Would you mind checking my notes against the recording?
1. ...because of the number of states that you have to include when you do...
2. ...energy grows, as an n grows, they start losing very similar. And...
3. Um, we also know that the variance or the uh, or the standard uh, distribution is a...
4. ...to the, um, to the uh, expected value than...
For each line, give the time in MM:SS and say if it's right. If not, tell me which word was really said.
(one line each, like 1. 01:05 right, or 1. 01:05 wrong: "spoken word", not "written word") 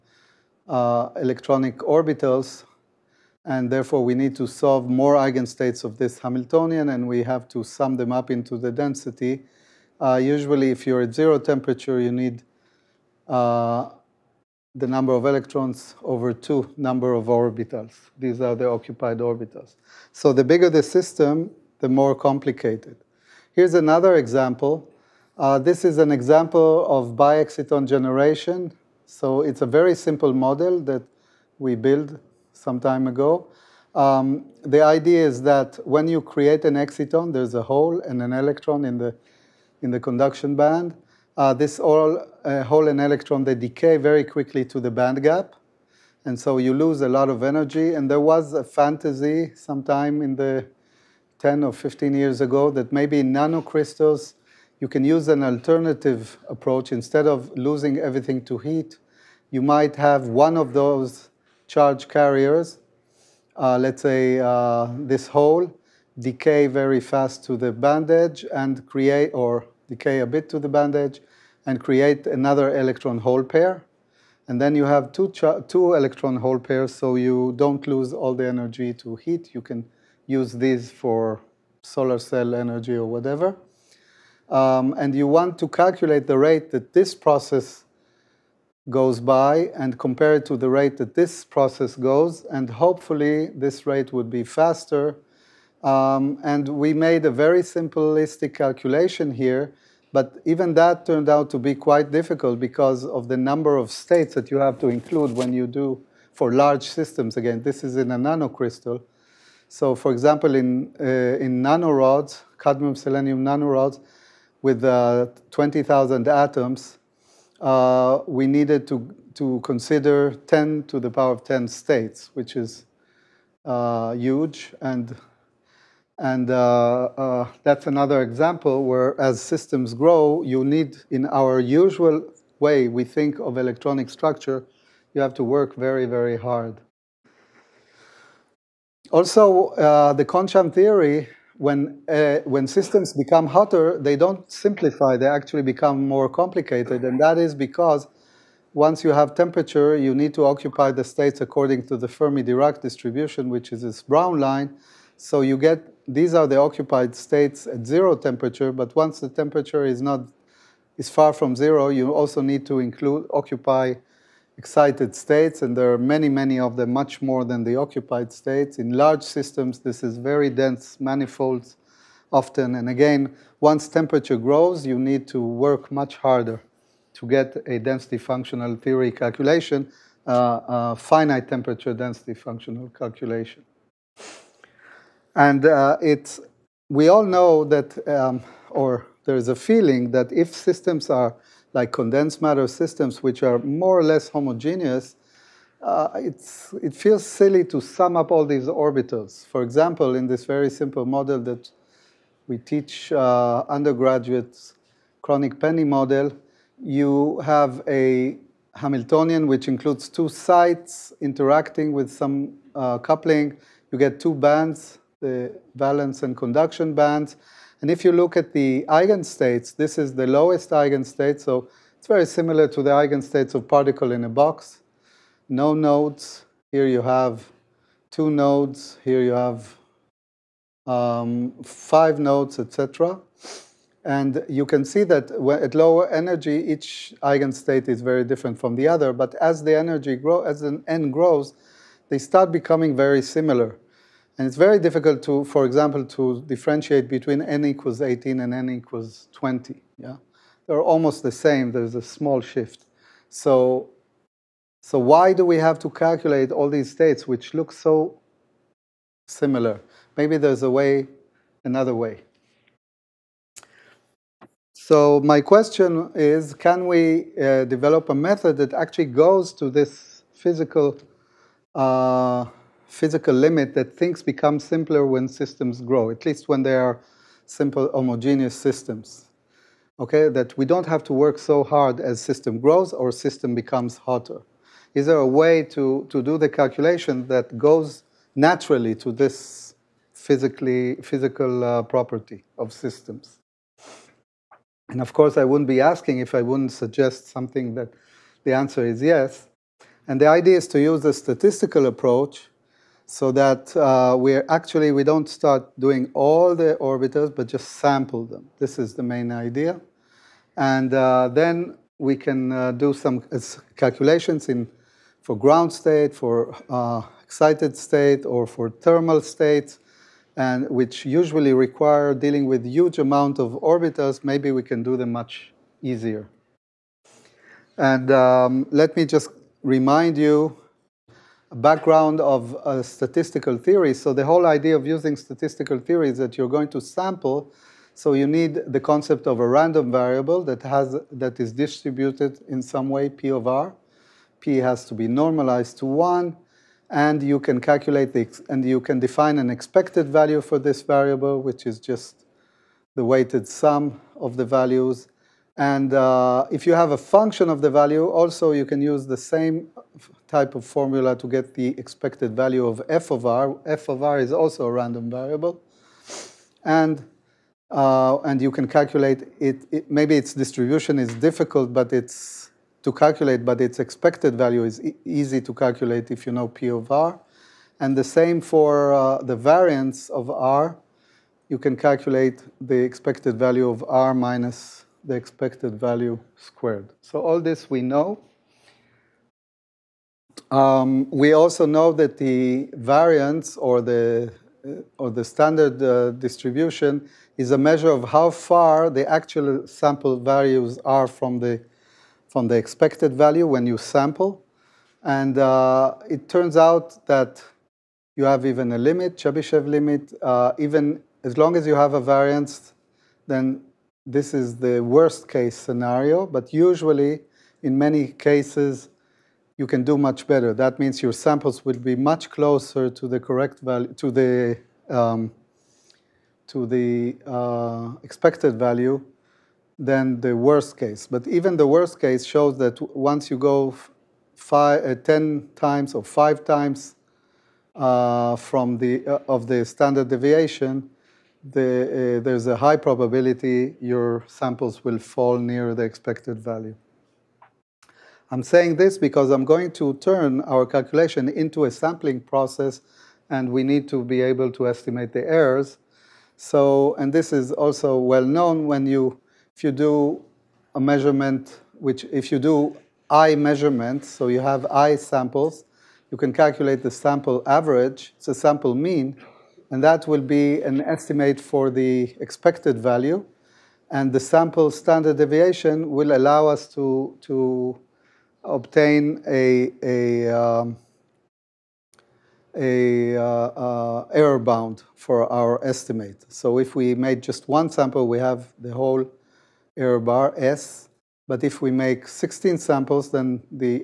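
1. 01:42 right
2. 03:59 wrong: "becoming", not "losing"
3. 06:30 right
4. 07:04 right.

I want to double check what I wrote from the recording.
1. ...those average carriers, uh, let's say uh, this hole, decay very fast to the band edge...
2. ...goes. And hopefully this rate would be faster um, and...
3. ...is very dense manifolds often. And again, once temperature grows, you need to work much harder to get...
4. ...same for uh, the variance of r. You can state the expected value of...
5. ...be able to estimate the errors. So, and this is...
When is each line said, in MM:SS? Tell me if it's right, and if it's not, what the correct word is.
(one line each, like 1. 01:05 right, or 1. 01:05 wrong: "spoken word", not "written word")
1. 01:00 wrong: "charge", not "average"
2. 01:31 right
3. 02:50 right
4. 06:18 wrong: "calculate", not "state"
5. 07:34 right.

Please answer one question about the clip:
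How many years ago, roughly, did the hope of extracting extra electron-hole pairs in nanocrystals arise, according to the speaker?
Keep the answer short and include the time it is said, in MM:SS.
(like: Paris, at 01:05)
10 or 15, at 00:51.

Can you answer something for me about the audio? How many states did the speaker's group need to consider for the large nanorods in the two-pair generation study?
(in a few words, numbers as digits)
10^10.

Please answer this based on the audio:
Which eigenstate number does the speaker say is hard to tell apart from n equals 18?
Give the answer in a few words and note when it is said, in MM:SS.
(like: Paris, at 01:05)
20, at 04:08.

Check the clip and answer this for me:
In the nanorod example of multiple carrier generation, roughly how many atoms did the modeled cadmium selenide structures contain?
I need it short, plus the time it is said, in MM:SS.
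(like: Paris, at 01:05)
20,000, at 01:55.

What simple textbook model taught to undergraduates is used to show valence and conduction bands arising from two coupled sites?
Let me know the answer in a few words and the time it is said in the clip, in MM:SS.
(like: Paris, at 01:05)
Kronig-Penney model, at 03:25.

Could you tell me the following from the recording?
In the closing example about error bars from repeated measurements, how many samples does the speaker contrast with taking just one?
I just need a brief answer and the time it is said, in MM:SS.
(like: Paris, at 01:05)
16, at 08:12.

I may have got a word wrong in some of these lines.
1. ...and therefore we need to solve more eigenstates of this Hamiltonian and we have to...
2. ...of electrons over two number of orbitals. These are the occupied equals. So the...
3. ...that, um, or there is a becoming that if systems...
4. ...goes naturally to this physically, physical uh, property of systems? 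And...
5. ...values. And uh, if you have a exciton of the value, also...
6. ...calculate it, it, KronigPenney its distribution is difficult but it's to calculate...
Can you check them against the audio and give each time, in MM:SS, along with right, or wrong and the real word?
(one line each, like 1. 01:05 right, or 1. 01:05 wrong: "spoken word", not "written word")
1. 00:03 right
2. 00:15 wrong: "orbitals", not "equals"
3. 03:07 wrong: "feeling", not "becoming"
4. 04:47 right
5. 05:54 wrong: "function", not "exciton"
6. 06:08 wrong: "Maybe", not "KronigPenney".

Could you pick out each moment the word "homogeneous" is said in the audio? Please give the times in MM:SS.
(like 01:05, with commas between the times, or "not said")
03:14, 04:37.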